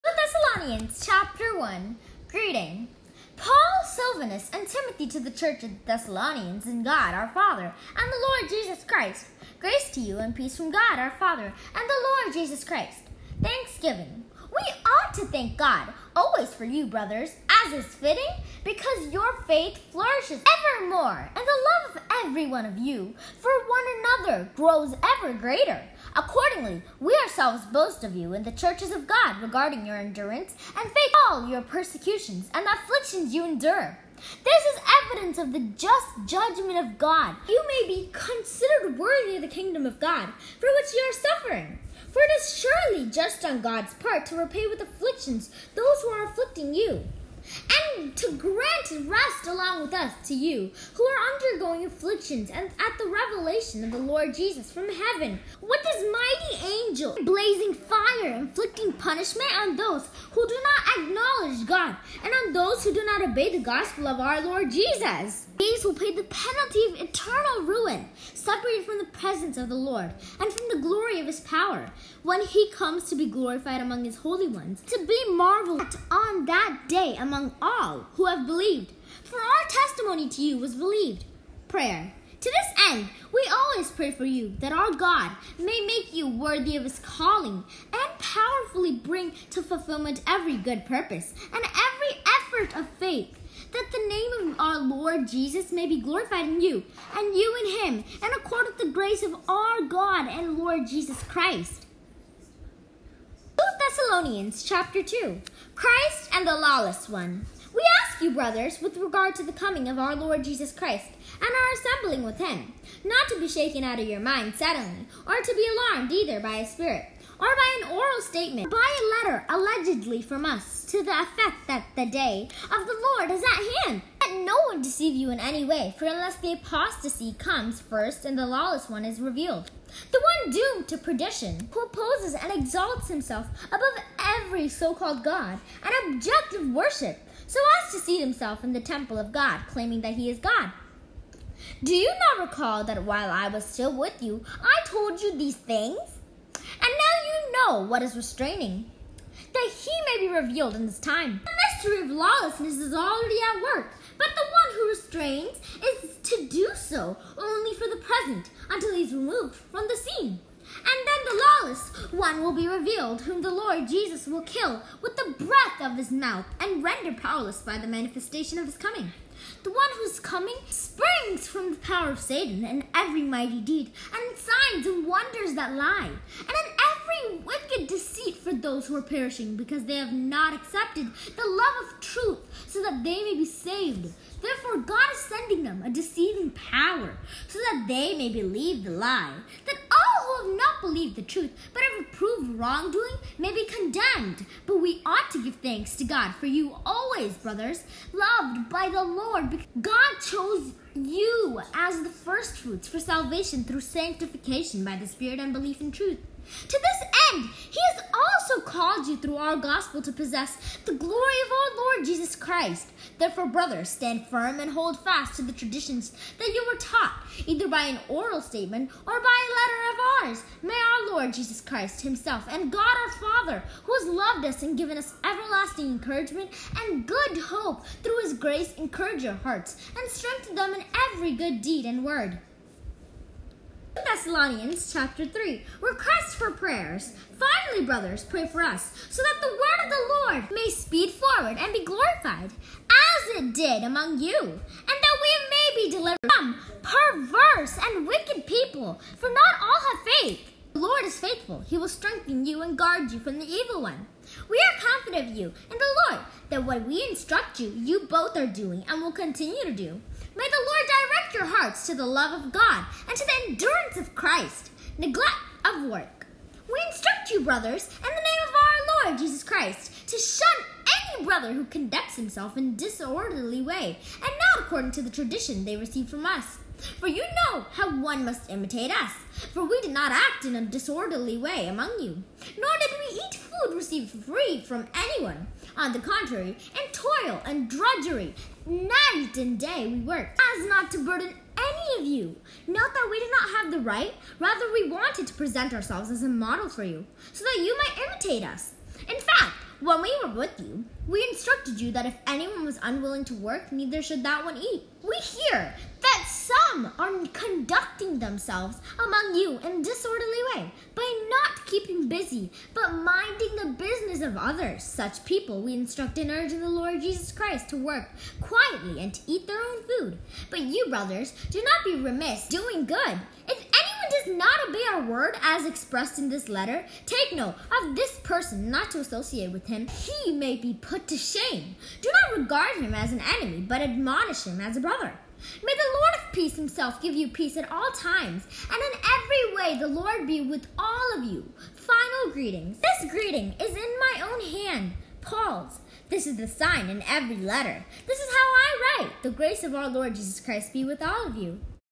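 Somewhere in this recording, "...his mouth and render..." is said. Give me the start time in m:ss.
2:45.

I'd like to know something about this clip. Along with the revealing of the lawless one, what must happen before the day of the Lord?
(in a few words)
the apostasy.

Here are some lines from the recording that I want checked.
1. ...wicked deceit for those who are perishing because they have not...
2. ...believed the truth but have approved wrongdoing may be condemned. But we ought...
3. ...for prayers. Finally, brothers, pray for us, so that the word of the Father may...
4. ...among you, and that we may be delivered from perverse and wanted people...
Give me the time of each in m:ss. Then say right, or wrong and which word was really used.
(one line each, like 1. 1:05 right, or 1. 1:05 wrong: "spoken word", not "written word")
1. 2:57 right
2. 3:10 right
3. 3:56 wrong: "Lord", not "Father"
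4. 4:03 wrong: "wicked", not "wanted".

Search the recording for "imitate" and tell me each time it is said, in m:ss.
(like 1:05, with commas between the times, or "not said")
4:38, 4:58.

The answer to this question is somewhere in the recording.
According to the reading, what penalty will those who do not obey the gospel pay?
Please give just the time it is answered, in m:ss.
1:07.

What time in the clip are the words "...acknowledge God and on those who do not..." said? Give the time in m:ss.
1:01.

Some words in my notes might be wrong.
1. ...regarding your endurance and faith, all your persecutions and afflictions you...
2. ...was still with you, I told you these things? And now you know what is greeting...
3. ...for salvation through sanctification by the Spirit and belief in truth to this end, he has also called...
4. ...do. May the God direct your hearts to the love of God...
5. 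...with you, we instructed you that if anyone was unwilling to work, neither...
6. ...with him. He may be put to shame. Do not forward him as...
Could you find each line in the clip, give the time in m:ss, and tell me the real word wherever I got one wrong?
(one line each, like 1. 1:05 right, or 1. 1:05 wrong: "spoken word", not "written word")
1. 0:29 right
2. 2:23 wrong: "restraining", not "greeting"
3. 3:22 right
4. 4:19 wrong: "Lord", not "God"
5. 5:00 right
6. 5:29 wrong: "regard", not "forward".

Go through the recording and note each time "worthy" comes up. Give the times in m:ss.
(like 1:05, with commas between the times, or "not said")
0:38, 1:26.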